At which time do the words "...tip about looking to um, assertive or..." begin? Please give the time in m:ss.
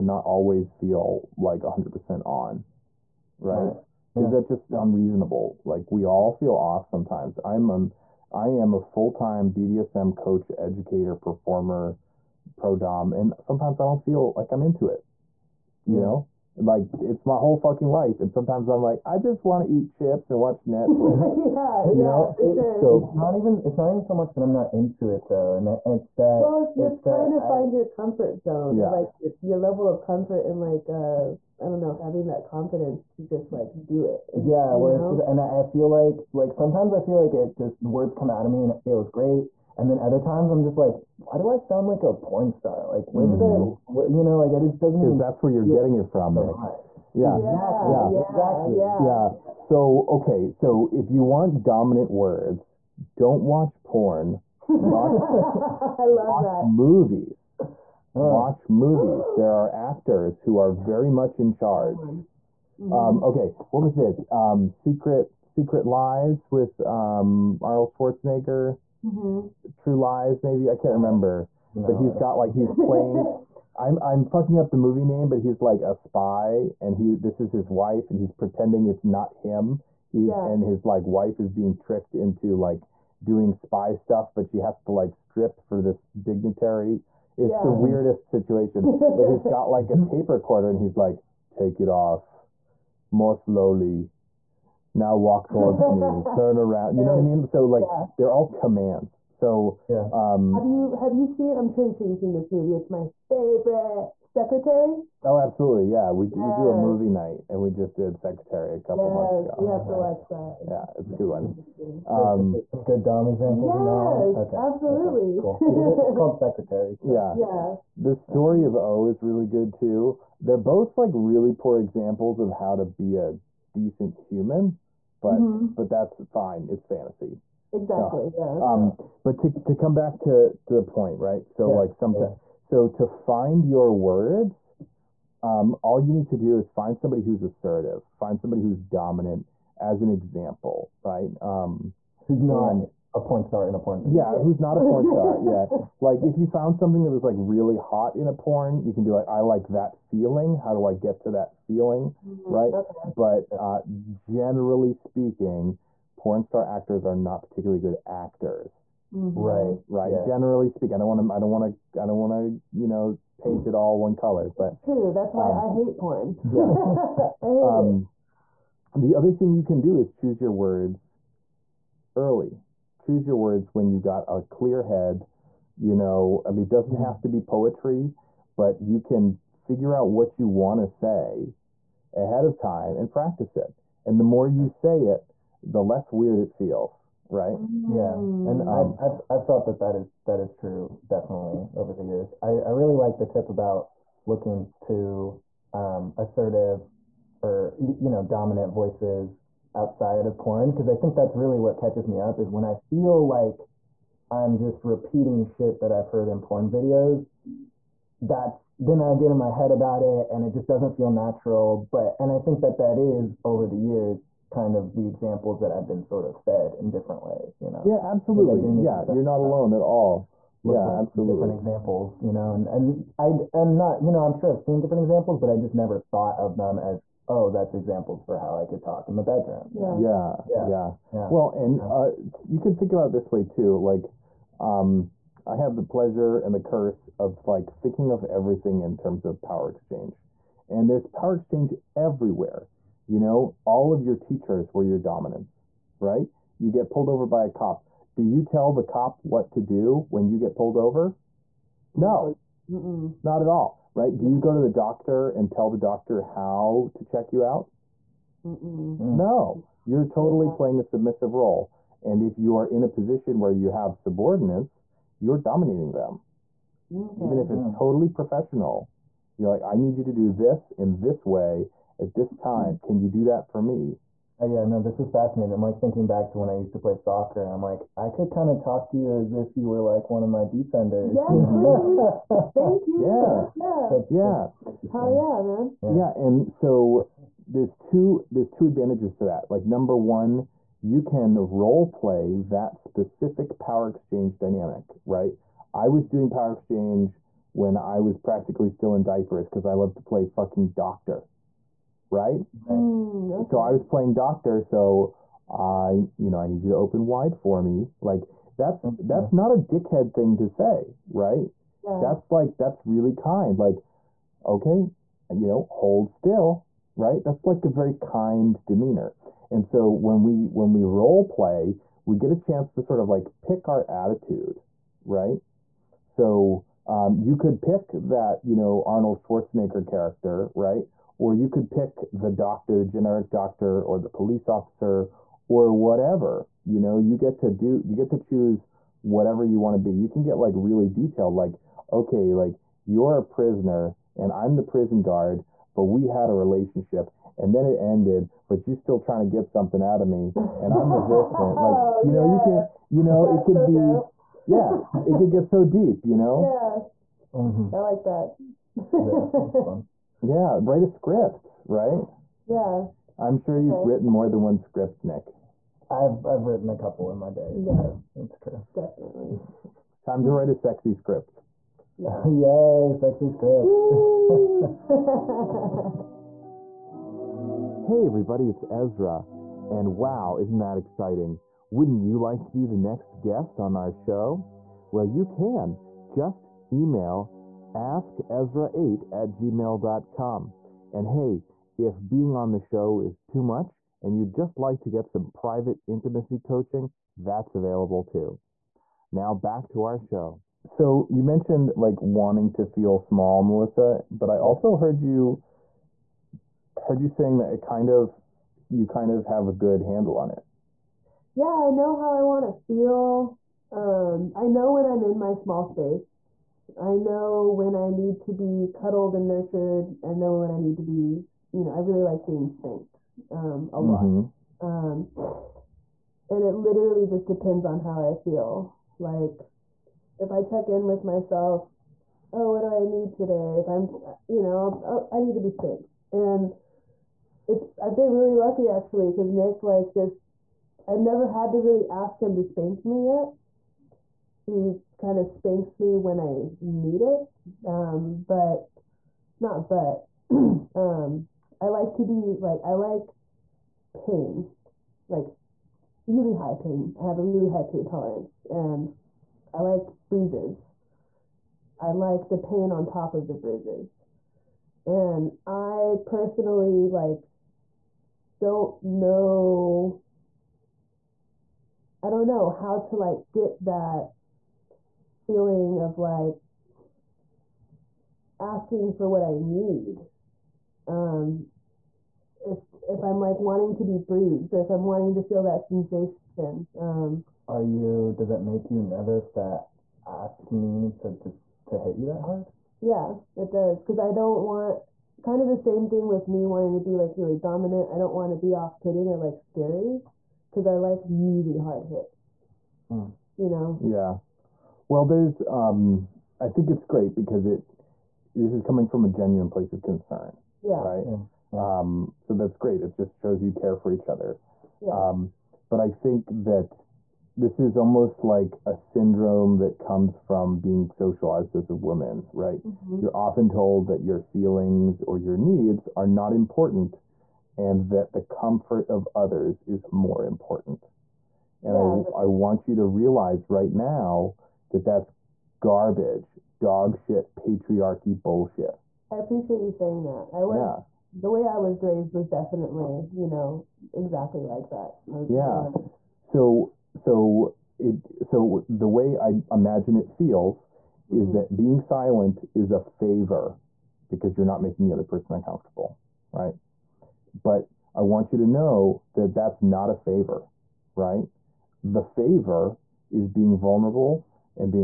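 3:13.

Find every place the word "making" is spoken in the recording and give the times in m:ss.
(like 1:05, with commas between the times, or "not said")
9:14.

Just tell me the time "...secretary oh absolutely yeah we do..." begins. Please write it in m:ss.
1:44.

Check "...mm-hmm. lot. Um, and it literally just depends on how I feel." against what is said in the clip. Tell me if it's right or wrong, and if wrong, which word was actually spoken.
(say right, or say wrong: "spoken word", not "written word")
right.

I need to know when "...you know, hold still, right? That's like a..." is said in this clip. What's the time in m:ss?
5:15.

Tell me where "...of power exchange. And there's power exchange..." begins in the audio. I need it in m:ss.
3:59.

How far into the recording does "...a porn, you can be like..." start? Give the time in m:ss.
2:28.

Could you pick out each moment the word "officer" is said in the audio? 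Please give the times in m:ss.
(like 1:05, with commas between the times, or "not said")
5:34.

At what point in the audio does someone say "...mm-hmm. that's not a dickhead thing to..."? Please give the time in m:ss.
5:08.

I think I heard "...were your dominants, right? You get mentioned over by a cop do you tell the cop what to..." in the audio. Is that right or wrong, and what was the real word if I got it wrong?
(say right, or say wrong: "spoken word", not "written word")
wrong: "pulled", not "mentioned".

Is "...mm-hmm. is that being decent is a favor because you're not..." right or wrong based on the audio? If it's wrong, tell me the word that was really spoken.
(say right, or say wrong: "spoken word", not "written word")
wrong: "silent", not "decent".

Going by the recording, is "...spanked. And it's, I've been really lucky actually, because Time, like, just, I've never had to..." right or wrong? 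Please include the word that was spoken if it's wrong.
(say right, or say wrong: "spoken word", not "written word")
wrong: "Nick", not "Time".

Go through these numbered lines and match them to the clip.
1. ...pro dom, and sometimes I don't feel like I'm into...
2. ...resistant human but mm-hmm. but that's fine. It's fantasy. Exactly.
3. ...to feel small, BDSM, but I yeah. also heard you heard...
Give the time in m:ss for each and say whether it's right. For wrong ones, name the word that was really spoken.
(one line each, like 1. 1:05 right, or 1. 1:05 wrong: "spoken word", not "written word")
1. 0:12 right
2. 2:03 wrong: "decent", not "resistant"
3. 6:42 wrong: "Melissa", not "BDSM".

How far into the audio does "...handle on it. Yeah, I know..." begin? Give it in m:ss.
6:49.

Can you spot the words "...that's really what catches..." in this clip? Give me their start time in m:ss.
3:21.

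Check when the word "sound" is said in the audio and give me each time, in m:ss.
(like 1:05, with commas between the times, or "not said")
0:41.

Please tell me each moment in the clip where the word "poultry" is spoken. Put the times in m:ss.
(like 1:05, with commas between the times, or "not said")
not said.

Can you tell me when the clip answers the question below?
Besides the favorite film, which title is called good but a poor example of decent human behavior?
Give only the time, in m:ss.
1:57.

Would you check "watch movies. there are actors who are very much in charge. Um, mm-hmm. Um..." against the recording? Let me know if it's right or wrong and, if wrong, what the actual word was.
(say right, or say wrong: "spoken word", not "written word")
right.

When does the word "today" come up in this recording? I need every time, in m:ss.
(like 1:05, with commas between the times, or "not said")
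7:13.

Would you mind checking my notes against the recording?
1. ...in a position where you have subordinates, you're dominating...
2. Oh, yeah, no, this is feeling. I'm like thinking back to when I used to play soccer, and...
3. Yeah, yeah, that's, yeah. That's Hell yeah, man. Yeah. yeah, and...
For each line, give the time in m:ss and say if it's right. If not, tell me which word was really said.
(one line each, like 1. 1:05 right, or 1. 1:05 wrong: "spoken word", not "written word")
1. 4:22 right
2. 4:34 wrong: "fascinating", not "feeling"
3. 4:42 right.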